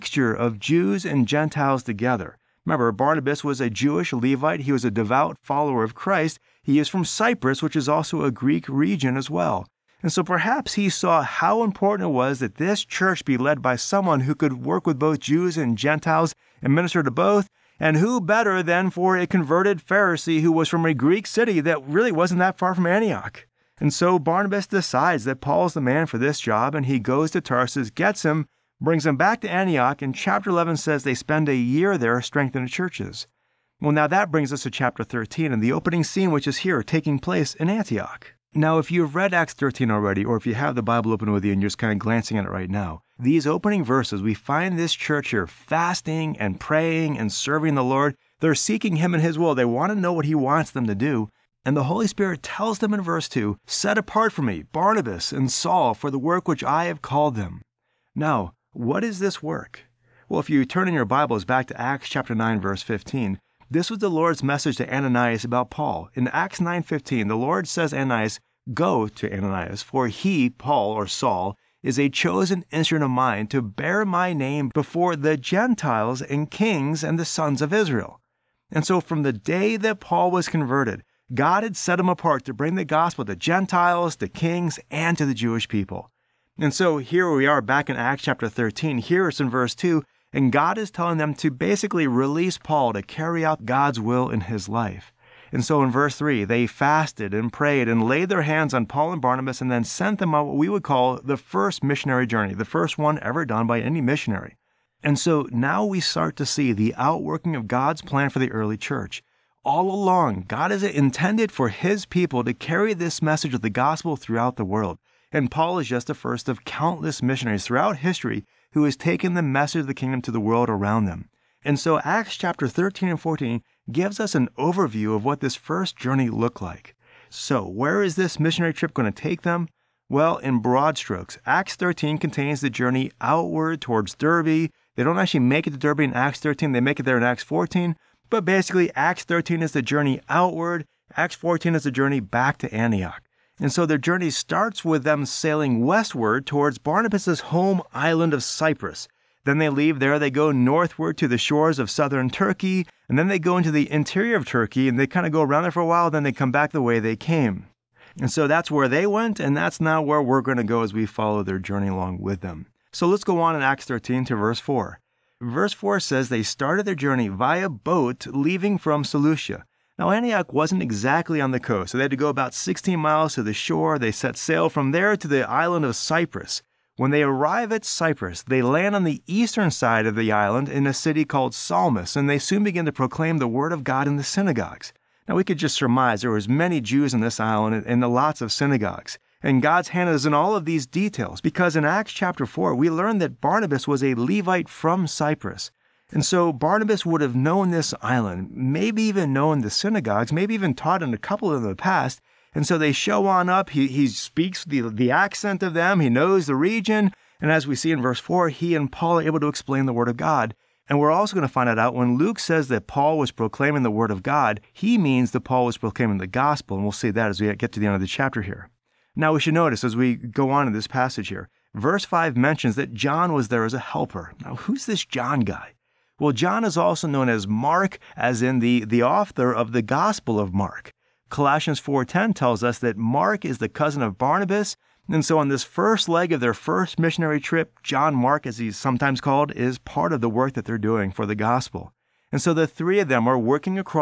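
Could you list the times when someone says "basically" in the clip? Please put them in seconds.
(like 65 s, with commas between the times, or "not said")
91 s, 138 s.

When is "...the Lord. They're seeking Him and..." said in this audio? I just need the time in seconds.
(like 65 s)
47 s.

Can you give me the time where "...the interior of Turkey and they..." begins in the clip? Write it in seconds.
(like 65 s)
153 s.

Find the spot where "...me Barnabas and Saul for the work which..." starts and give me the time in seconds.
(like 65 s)
54 s.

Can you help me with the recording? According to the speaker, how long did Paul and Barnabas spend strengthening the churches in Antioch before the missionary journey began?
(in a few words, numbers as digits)
a year.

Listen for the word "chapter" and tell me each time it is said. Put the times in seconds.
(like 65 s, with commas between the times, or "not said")
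30 s, 34 s, 62 s, 88 s, 122 s, 192 s, 218 s.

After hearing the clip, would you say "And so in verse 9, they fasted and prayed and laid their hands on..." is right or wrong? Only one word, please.
wrong.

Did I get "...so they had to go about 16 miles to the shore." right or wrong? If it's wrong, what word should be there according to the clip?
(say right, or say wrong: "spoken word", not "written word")
right.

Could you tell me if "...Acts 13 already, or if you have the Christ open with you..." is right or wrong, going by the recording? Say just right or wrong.
wrong.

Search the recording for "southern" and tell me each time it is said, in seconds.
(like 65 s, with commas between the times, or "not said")
151 s.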